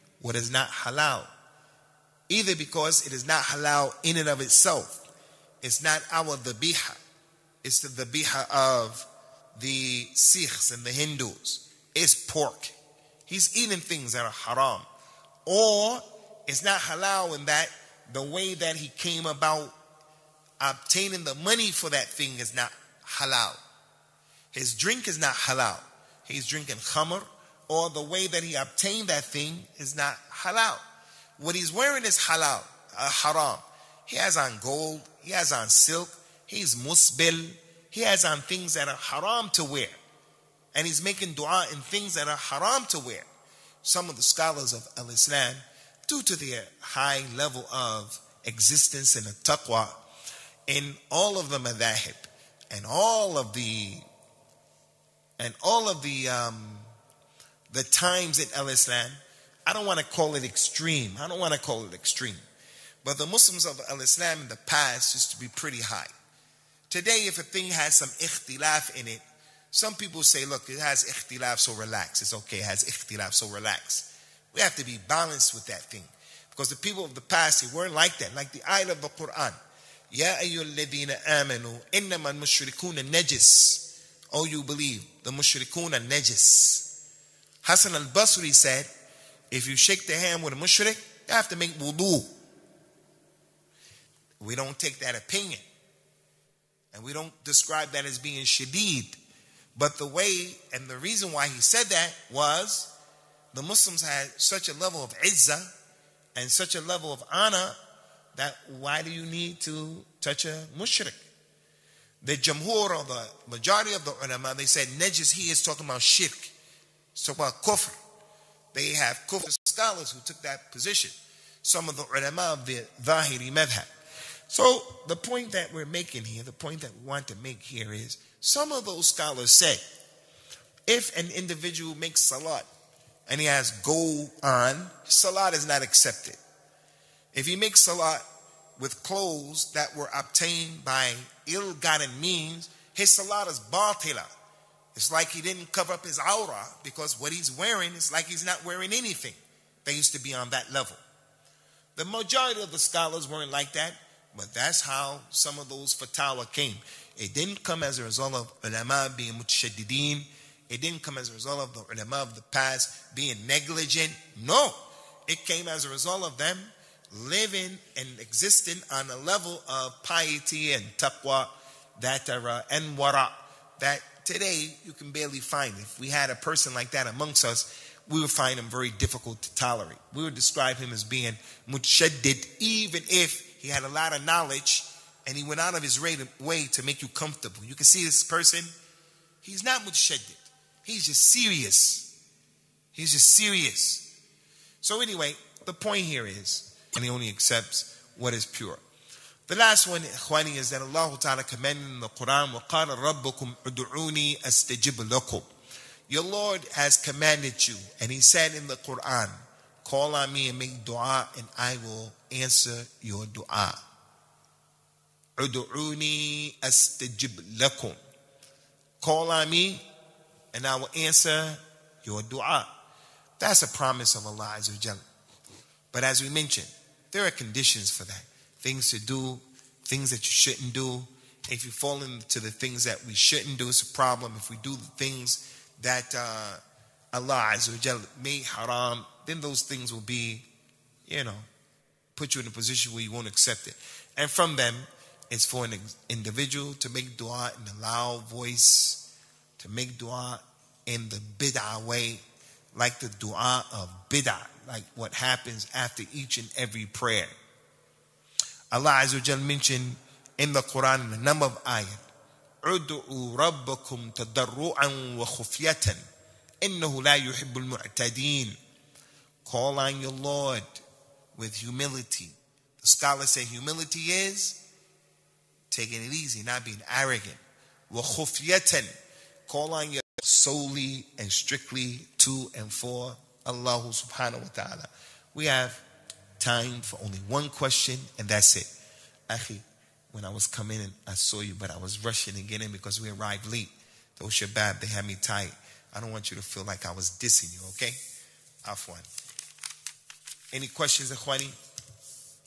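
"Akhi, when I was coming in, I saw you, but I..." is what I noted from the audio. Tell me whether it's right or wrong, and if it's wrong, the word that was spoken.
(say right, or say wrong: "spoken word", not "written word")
right.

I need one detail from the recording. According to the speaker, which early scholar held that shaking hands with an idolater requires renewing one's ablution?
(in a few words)
Hassan al-Basri.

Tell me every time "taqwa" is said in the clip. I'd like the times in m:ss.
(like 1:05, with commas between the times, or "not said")
0:49, 2:50.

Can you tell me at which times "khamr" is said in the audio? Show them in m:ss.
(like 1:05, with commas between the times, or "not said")
0:26.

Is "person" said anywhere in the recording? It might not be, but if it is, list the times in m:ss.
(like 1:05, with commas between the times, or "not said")
2:56, 3:08.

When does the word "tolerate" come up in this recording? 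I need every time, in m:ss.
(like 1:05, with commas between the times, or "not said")
2:59.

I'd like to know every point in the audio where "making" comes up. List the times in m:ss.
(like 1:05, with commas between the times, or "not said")
0:41, 2:05.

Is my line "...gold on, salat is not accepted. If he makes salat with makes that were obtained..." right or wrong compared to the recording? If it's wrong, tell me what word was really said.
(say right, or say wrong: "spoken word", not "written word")
wrong: "clothes", not "makes".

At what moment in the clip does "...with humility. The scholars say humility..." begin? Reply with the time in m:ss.
4:31.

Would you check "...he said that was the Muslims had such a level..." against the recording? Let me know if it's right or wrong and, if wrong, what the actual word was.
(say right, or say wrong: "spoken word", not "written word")
right.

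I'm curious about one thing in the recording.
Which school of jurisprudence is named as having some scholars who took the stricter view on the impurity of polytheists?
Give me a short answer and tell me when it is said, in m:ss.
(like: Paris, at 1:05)
Zahiri, at 2:03.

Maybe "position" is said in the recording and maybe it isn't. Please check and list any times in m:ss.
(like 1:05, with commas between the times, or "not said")
2:00, 4:02.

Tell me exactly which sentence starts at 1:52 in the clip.
The jamhur or the majority of the ulama, they said najis, he is talking about shirk.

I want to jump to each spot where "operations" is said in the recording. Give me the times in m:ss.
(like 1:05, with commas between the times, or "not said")
not said.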